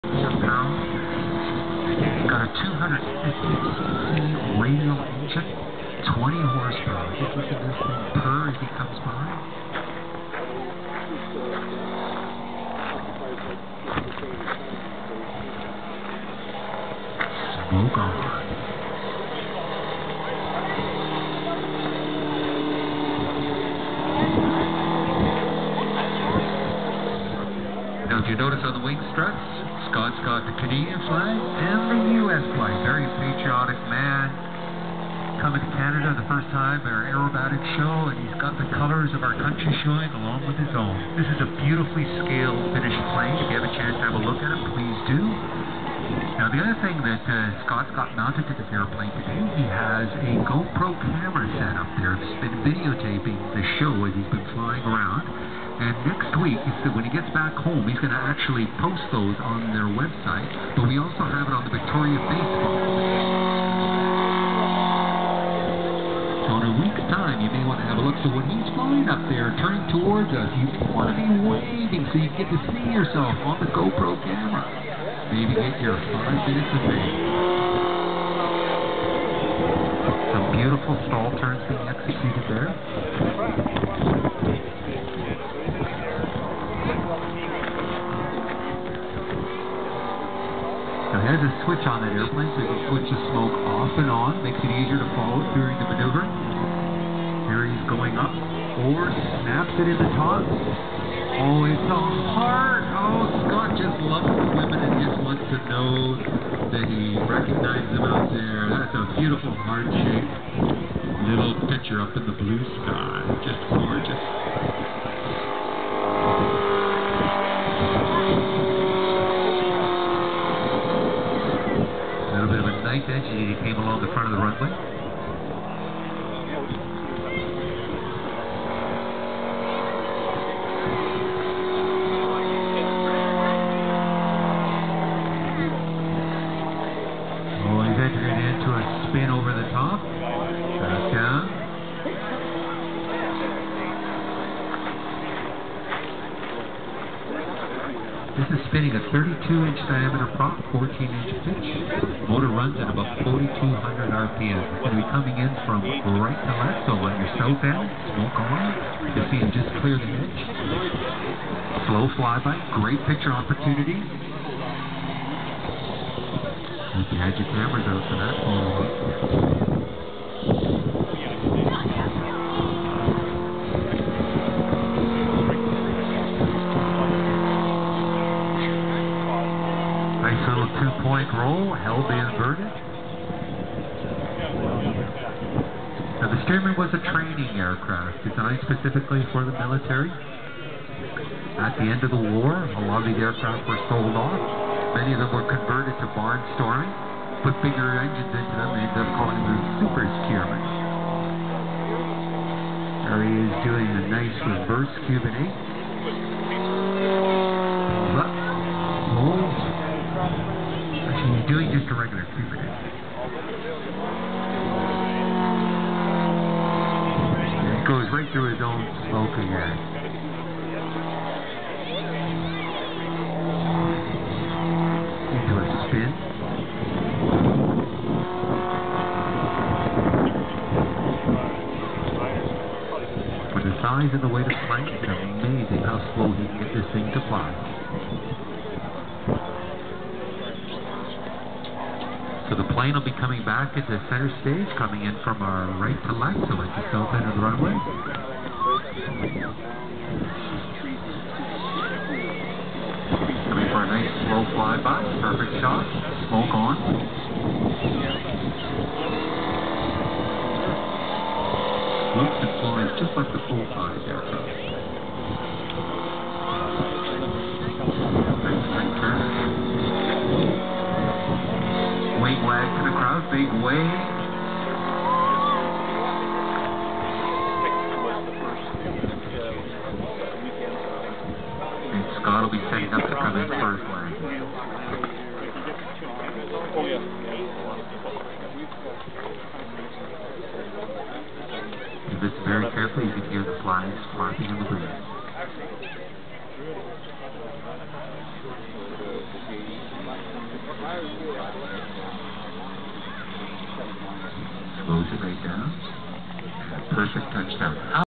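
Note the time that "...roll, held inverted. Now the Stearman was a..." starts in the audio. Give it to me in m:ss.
3:01.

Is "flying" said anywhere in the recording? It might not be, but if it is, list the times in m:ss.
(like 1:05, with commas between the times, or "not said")
0:54, 1:08.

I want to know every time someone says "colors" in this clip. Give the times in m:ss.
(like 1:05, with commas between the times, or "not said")
0:38.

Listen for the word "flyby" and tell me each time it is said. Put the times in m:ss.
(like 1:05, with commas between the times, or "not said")
2:42, 4:14.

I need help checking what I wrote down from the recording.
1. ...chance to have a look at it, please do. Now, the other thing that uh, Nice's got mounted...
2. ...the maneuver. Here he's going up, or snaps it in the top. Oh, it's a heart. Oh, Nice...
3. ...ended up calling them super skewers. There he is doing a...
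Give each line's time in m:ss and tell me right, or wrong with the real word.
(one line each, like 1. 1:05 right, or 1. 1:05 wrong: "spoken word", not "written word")
1. 0:43 wrong: "Scott", not "Nice"
2. 1:35 wrong: "Scott", not "Nice"
3. 3:18 right.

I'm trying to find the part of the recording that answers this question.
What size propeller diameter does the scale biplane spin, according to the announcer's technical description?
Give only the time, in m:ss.
2:29.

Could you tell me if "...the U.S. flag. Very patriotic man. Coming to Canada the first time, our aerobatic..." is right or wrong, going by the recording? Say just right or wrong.
right.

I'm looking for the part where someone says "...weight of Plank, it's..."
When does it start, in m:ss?
3:54.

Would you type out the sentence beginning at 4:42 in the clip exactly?
Scott'll be setting up to come in first.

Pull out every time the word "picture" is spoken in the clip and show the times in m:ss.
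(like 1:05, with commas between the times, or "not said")
1:51, 2:43.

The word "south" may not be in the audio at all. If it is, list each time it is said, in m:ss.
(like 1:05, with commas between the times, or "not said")
2:37, 4:06.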